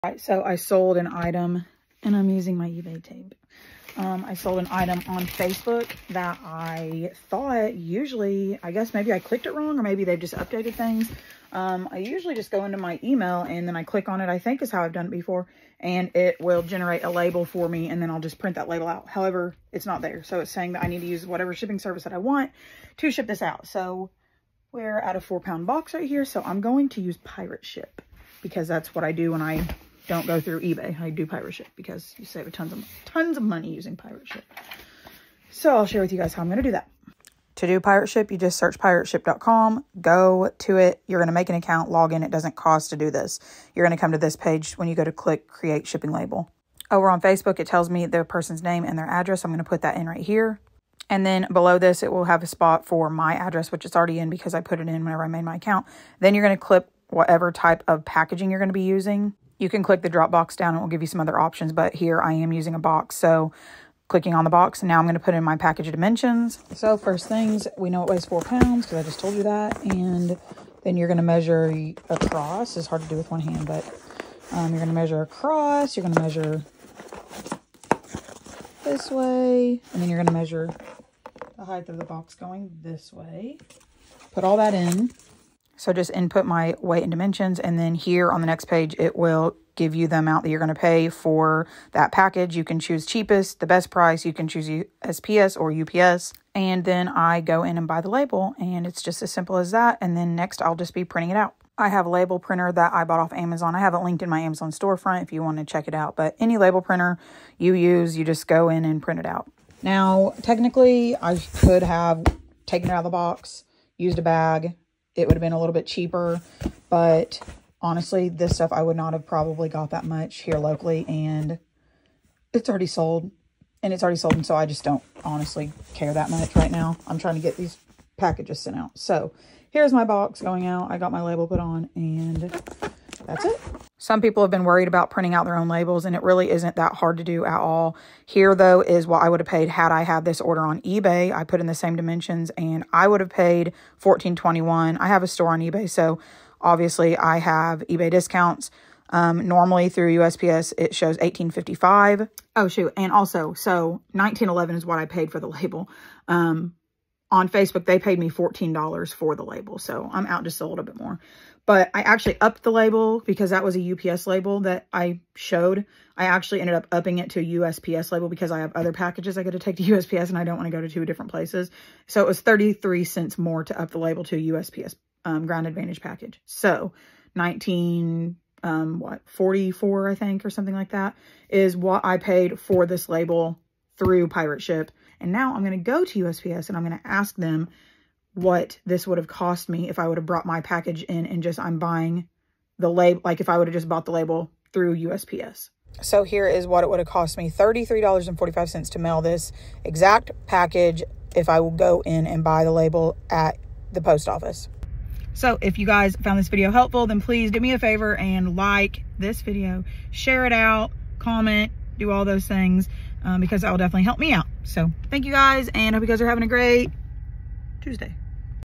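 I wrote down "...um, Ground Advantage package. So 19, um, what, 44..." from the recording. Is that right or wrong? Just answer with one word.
right.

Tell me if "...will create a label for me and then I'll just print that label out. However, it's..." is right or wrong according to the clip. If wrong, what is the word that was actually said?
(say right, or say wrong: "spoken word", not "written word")
wrong: "generate", not "create".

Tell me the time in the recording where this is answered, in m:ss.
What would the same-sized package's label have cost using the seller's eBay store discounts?
2:23.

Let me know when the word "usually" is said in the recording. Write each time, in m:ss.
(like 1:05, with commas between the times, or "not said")
0:07, 0:11.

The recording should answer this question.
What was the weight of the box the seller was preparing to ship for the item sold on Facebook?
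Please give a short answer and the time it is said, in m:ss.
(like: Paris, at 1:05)
4 pounds, at 0:25.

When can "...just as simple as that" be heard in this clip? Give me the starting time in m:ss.
1:39.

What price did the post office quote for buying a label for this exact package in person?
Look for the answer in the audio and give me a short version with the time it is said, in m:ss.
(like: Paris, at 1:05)
$33.45, at 3:17.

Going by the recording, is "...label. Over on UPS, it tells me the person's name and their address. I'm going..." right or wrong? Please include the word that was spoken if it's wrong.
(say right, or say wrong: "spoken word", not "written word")
wrong: "Facebook", not "UPS".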